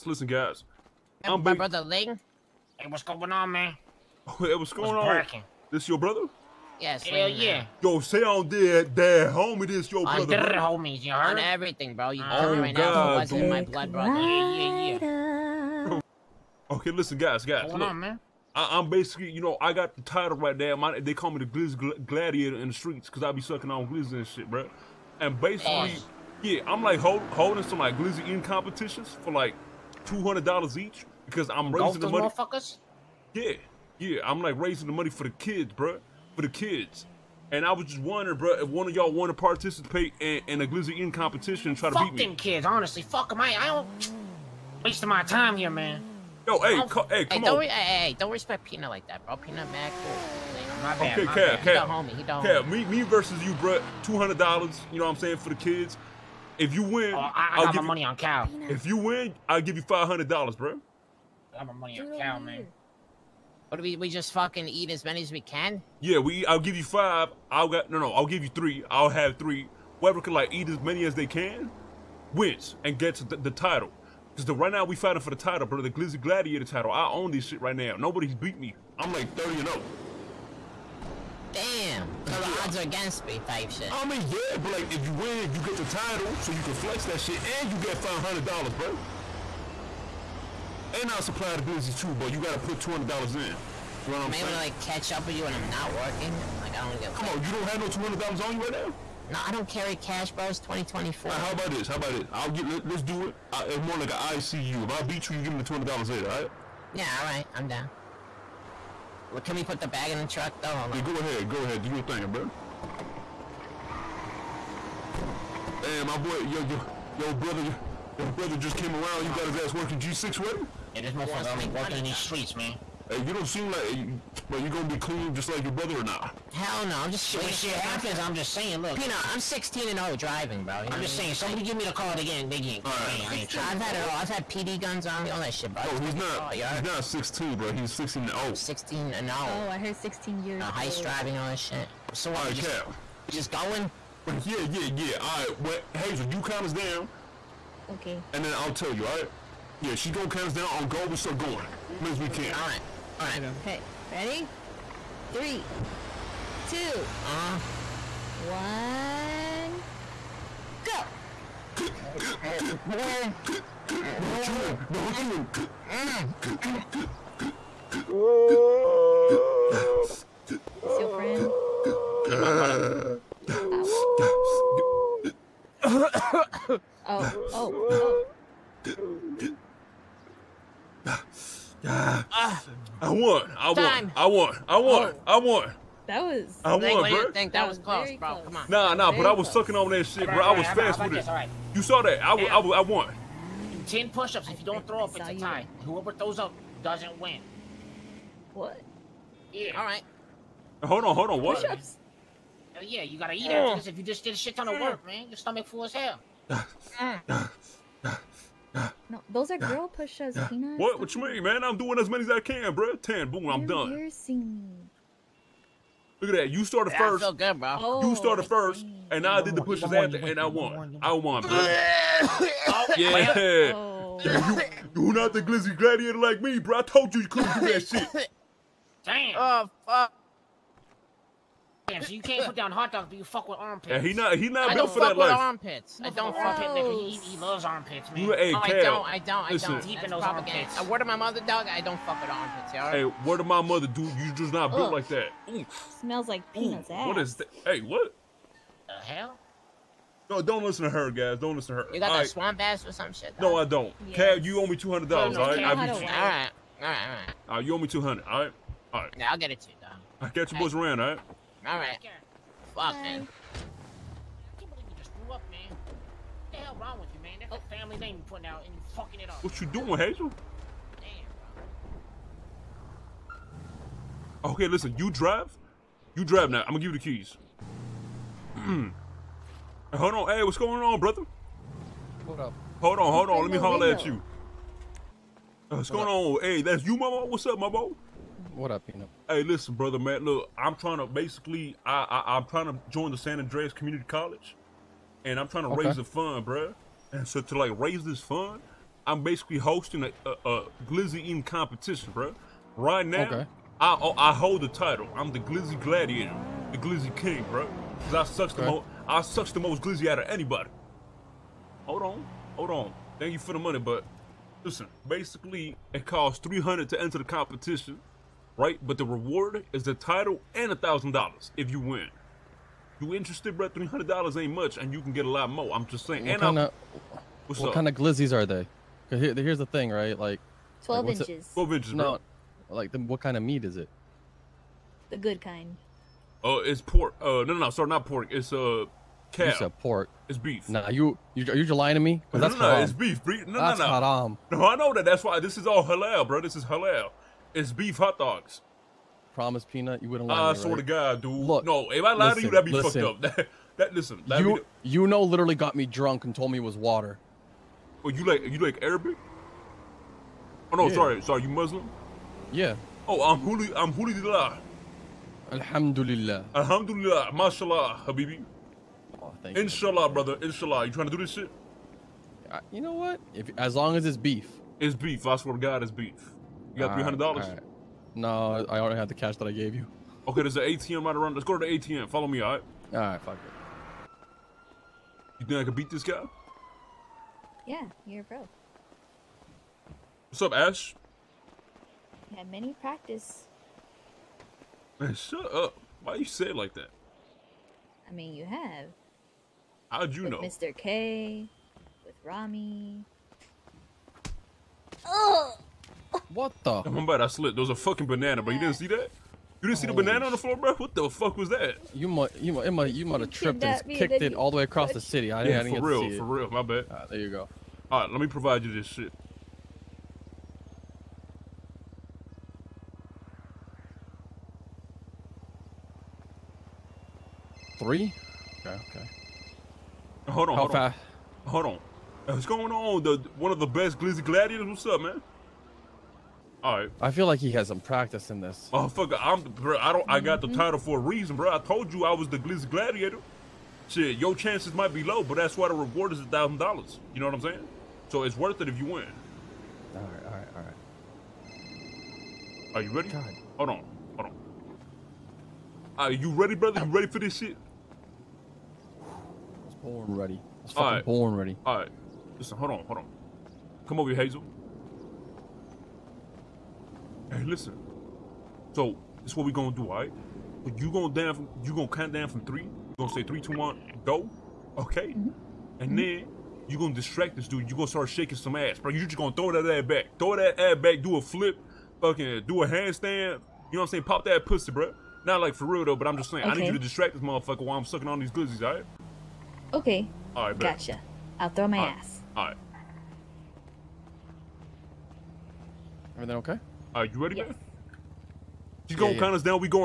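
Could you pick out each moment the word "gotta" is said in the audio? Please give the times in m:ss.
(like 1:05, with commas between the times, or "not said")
1:32, 3:23.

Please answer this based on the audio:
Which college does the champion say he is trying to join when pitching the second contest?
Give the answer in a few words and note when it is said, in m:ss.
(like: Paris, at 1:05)
San Andreas Community College, at 4:53.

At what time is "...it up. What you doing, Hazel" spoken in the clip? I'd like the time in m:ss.
4:29.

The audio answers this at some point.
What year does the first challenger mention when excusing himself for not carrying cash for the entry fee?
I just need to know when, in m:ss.
1:40.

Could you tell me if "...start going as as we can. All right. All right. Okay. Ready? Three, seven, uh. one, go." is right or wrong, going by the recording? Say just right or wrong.
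wrong.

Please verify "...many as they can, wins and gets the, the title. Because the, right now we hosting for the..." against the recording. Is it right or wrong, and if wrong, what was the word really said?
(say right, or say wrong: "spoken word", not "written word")
wrong: "fighting", not "hosting".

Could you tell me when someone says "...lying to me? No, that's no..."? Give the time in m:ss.
5:41.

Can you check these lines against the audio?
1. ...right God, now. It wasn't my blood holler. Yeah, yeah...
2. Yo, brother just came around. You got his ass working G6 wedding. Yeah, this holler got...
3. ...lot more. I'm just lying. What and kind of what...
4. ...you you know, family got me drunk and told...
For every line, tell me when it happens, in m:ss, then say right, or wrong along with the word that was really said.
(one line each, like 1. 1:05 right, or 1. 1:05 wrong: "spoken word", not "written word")
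1. 0:12 wrong: "brother", not "holler"
2. 1:58 wrong: "motherfucker", not "holler"
3. 5:25 wrong: "saying", not "lying"
4. 5:54 wrong: "literally", not "family".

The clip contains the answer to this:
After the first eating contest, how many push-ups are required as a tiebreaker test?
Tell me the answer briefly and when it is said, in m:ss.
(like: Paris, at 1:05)
10, at 3:13.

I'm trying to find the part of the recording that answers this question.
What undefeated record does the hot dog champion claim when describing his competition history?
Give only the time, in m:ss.
1:19.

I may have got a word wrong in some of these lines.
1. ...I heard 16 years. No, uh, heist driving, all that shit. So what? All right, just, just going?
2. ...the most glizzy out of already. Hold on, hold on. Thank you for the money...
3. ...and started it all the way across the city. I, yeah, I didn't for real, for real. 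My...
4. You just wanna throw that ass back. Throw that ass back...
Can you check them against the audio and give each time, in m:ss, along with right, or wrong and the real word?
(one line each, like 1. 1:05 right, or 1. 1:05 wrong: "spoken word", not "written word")
1. 2:19 right
2. 5:09 wrong: "anybody", not "already"
3. 6:53 wrong: "kicked", not "started"
4. 7:58 wrong: "gonna", not "wanna".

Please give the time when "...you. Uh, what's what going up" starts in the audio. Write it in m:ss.
4:44.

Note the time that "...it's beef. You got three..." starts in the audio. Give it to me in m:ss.
6:15.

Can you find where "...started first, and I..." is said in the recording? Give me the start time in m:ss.
3:38.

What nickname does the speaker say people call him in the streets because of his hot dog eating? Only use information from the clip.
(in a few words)
Glizz Gladiator.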